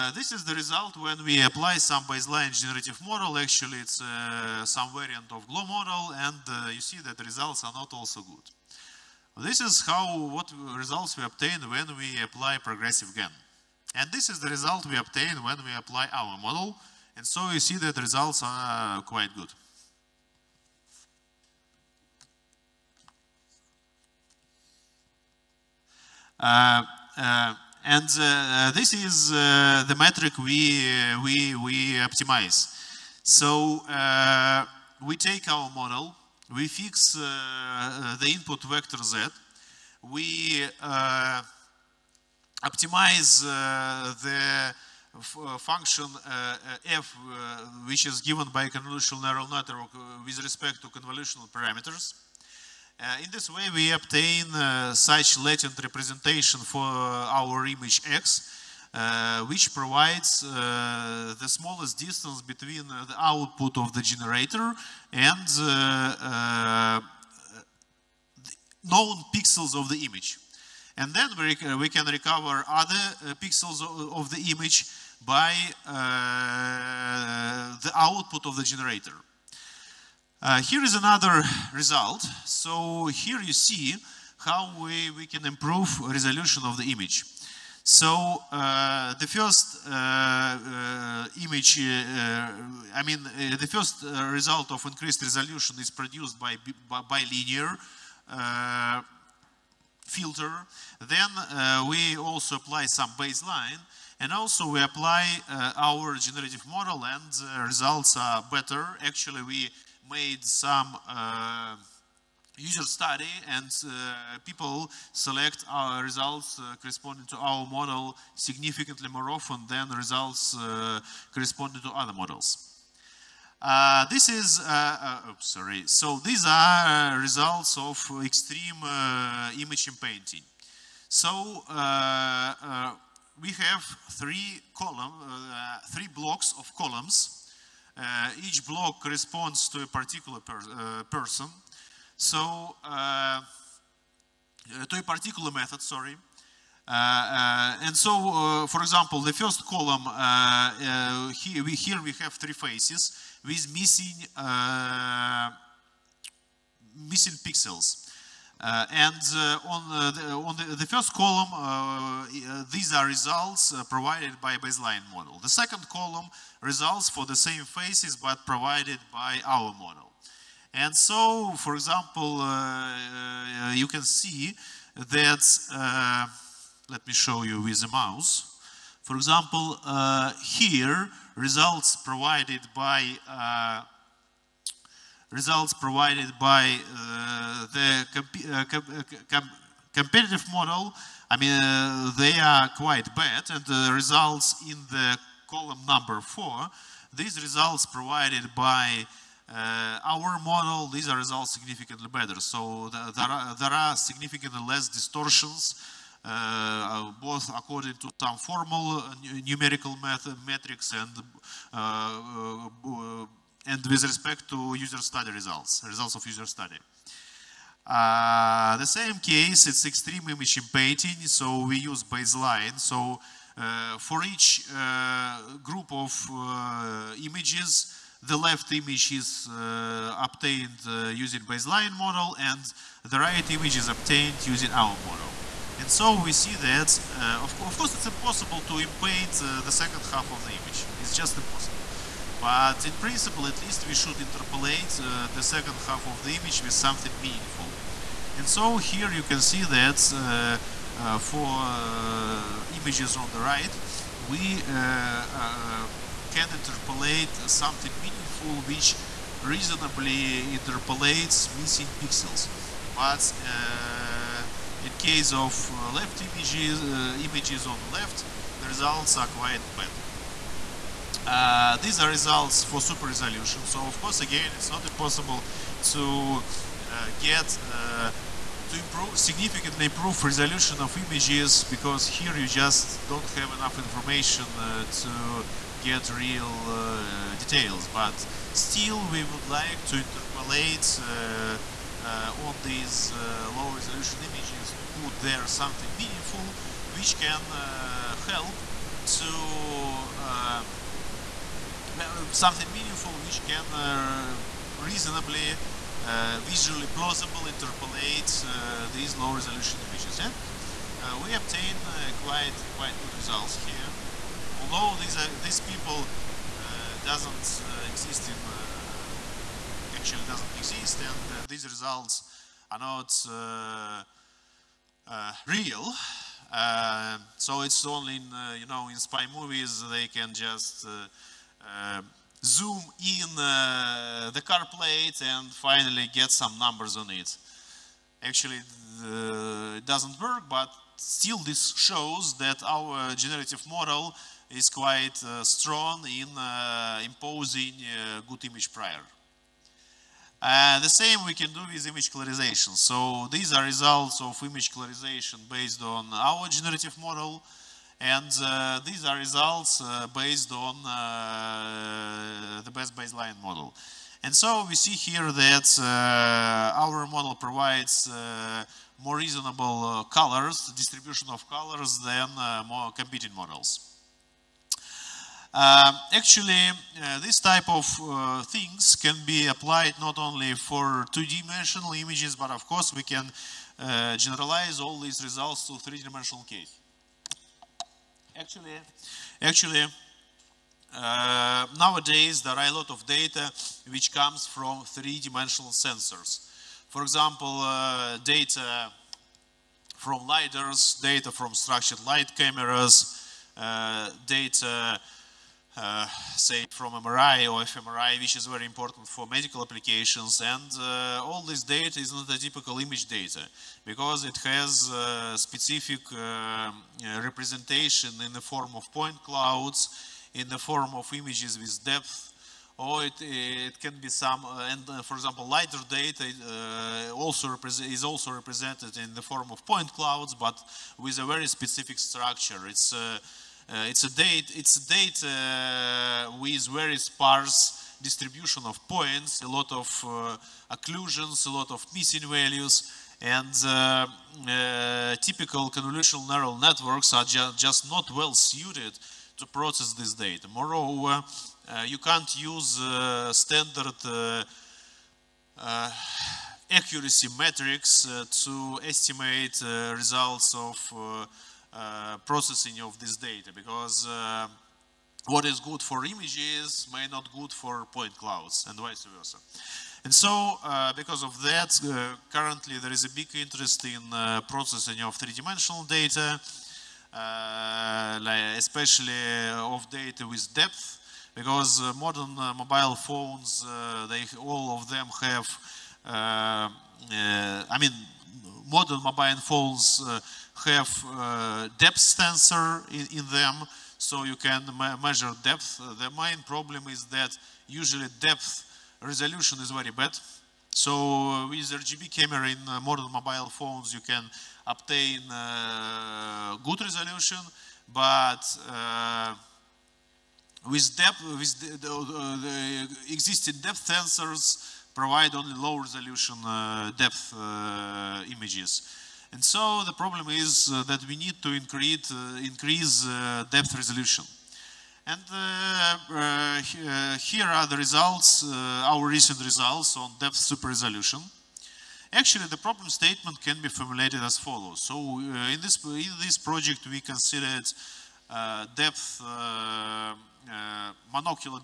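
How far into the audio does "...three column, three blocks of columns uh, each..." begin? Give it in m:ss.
2:14.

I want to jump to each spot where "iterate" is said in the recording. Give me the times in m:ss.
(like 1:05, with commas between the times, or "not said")
not said.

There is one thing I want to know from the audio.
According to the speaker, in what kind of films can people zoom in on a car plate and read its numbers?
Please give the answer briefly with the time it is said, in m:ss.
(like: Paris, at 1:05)
Spy movies, at 5:28.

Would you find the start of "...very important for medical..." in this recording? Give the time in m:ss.
6:48.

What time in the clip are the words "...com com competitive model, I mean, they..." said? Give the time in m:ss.
3:08.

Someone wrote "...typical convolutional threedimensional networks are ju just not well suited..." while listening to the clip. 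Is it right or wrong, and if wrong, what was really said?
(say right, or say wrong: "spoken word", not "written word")
wrong: "neural", not "threedimensional".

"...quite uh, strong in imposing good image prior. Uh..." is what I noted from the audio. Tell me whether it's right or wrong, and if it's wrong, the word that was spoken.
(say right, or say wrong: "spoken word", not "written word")
right.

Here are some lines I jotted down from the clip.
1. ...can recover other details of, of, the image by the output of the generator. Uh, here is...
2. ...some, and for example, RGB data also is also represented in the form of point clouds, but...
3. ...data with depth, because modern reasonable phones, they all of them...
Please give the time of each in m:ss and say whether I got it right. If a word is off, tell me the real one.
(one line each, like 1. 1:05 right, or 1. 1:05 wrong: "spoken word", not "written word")
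1. 1:11 wrong: "pixels", not "details"
2. 7:04 wrong: "LiDAR", not "RGB"
3. 7:59 wrong: "mobile", not "reasonable".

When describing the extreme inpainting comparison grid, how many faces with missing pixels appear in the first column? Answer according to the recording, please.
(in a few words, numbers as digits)
3.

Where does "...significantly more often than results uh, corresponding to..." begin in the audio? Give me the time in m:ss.
1:58.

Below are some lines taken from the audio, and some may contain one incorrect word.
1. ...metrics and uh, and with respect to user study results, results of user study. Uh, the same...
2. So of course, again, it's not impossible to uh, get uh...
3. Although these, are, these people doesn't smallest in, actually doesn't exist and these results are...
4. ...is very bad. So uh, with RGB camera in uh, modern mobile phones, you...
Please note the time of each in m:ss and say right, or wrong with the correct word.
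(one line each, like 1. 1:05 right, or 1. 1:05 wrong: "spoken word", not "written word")
1. 3:30 right
2. 4:33 right
3. 5:14 wrong: "exist", not "smallest"
4. 8:19 right.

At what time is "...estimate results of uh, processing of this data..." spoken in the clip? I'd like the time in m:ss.
7:38.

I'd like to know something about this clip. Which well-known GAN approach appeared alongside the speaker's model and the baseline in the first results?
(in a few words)
Progressive GAN.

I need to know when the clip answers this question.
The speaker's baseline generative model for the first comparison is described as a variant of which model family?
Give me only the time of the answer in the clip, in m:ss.
0:05.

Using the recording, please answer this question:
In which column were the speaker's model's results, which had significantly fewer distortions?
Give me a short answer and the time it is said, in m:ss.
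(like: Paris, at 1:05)
4, at 3:15.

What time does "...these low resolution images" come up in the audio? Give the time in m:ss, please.
5:08.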